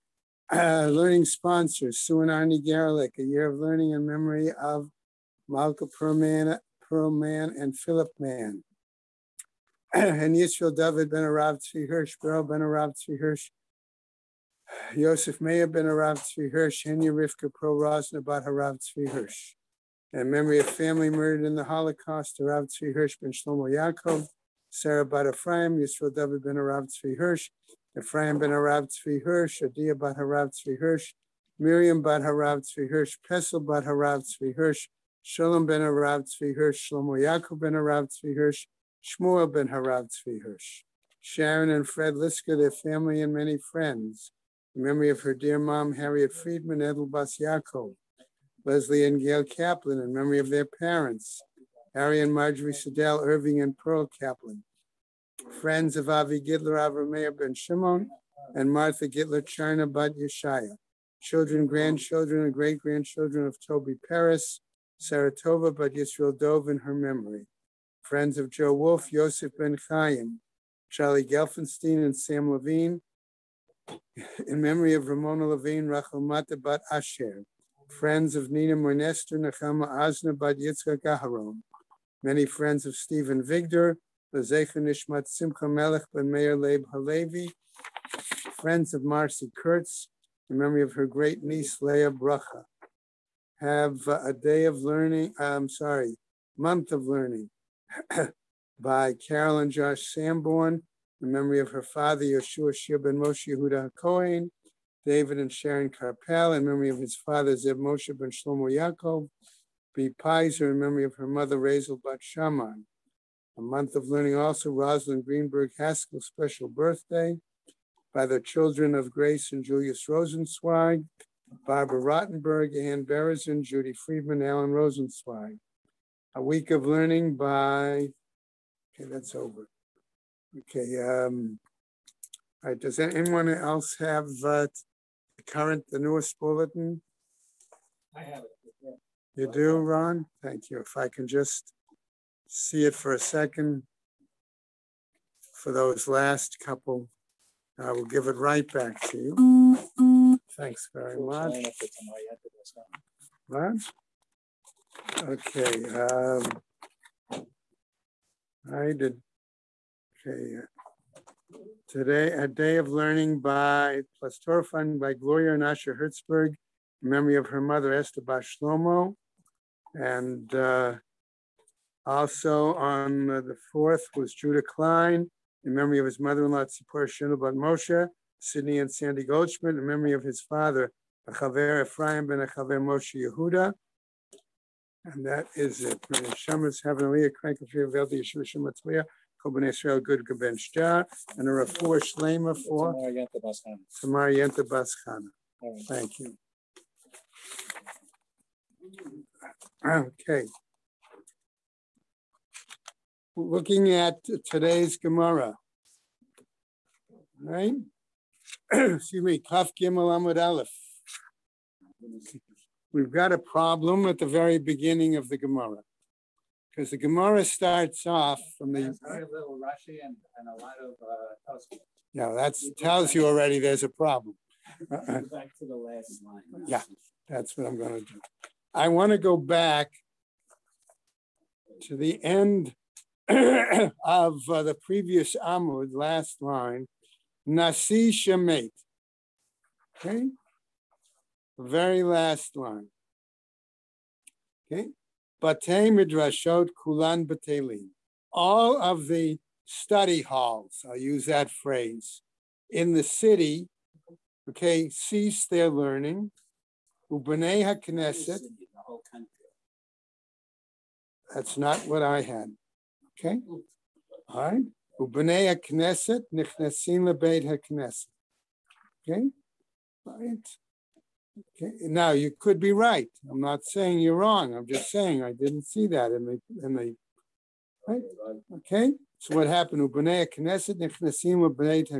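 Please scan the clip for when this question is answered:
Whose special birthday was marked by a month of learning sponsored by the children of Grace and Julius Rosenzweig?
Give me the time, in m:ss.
1:54.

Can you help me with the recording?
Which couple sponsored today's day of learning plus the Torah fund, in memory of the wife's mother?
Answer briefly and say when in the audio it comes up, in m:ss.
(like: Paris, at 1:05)
Gloria and Asher Hertzberg, at 2:45.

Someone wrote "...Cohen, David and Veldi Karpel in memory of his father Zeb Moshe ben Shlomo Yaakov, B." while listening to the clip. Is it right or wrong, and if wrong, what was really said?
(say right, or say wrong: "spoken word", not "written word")
wrong: "Sharon", not "Veldi".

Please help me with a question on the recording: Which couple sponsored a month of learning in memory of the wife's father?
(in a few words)
Carol and Josh Sanborn.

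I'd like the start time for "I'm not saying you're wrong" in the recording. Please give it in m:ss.
4:33.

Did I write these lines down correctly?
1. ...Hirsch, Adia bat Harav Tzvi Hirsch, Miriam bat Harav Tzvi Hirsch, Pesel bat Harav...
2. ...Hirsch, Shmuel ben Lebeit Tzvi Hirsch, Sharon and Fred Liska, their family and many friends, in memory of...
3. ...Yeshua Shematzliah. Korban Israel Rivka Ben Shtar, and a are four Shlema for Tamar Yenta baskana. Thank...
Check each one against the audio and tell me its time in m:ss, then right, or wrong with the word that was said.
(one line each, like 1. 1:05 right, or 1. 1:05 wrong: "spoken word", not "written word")
1. 0:29 right
2. 0:38 wrong: "Harav", not "Lebeit"
3. 3:08 wrong: "Good", not "Rivka".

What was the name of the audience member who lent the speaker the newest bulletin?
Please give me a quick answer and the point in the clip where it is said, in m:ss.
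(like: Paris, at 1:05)
Ron, at 2:19.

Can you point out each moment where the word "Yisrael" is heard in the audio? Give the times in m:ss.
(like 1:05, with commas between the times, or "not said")
0:10, 0:25, 1:05.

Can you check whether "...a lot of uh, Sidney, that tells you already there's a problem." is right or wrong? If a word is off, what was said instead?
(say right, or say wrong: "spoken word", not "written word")
wrong: "Yeah", not "Sidney".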